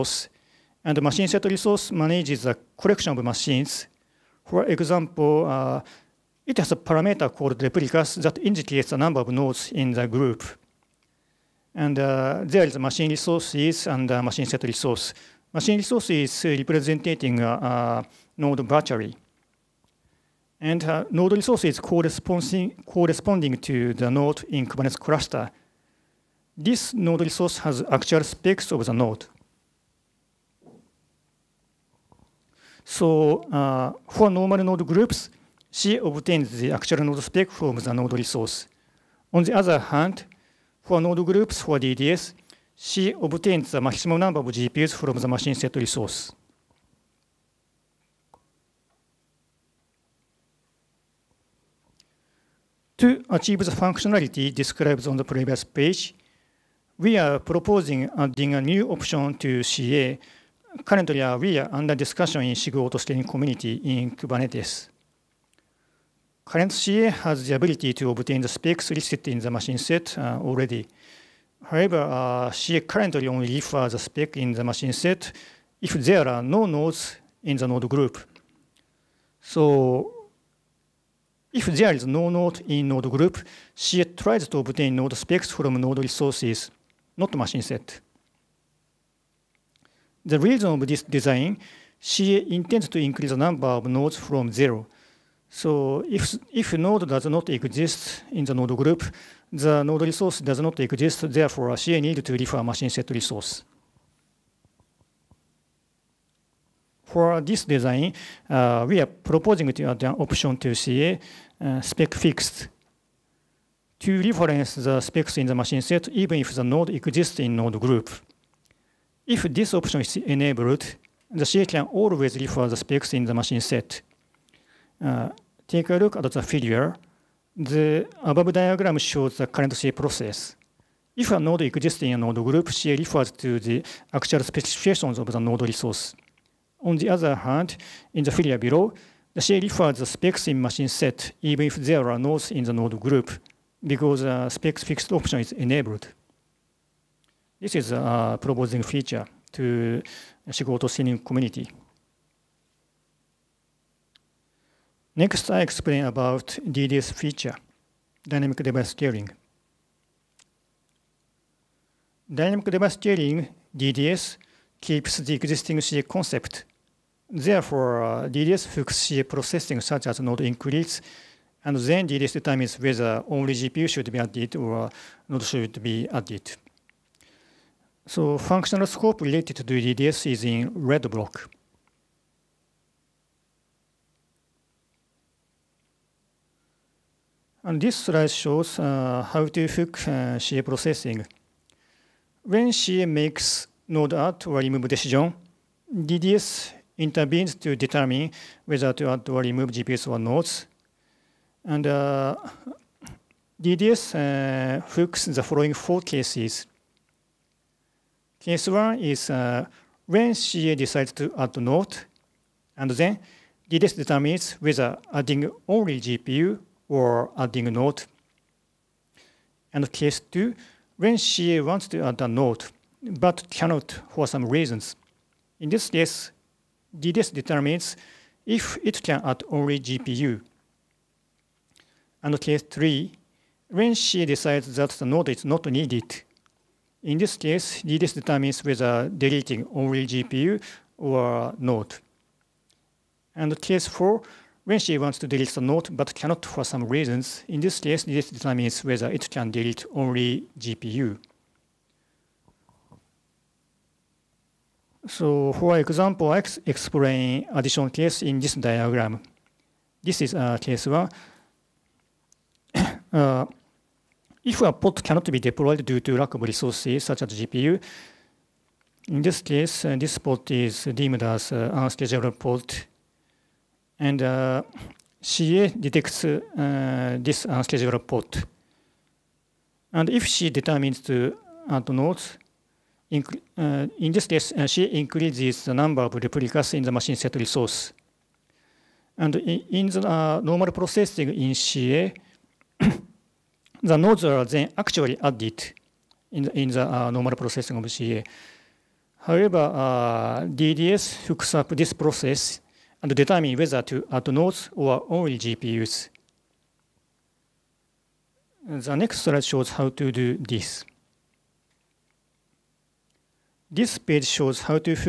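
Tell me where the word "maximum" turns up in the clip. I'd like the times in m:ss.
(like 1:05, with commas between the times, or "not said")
0:43.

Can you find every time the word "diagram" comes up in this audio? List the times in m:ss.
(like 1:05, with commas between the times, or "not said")
2:08, 4:18.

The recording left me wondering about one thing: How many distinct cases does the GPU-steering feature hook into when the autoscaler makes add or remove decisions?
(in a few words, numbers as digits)
4.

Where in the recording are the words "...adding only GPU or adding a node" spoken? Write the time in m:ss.
3:35.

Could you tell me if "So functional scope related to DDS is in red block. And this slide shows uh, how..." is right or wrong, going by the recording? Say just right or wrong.
right.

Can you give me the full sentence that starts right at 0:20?
And uh, node resource is corresponding, corresponding to the node in Kubernetes cluster.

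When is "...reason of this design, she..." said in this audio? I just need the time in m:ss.
1:30.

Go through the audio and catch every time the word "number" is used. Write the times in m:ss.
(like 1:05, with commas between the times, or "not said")
0:08, 0:44, 1:33, 4:45.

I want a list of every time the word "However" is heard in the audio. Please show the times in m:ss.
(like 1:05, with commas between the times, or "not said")
1:11, 4:59.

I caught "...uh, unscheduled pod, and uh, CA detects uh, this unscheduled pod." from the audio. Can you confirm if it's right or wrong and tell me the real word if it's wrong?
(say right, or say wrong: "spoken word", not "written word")
right.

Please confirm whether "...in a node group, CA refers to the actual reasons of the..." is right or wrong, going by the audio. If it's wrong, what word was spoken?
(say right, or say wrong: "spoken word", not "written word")
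wrong: "specifications", not "reasons".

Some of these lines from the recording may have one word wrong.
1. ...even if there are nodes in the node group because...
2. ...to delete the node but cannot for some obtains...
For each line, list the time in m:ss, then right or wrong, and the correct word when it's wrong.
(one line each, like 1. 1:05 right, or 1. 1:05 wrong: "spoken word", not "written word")
1. 2:21 right
2. 4:05 wrong: "reasons", not "obtains".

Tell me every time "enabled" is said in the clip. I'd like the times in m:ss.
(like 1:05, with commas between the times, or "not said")
2:00, 2:25.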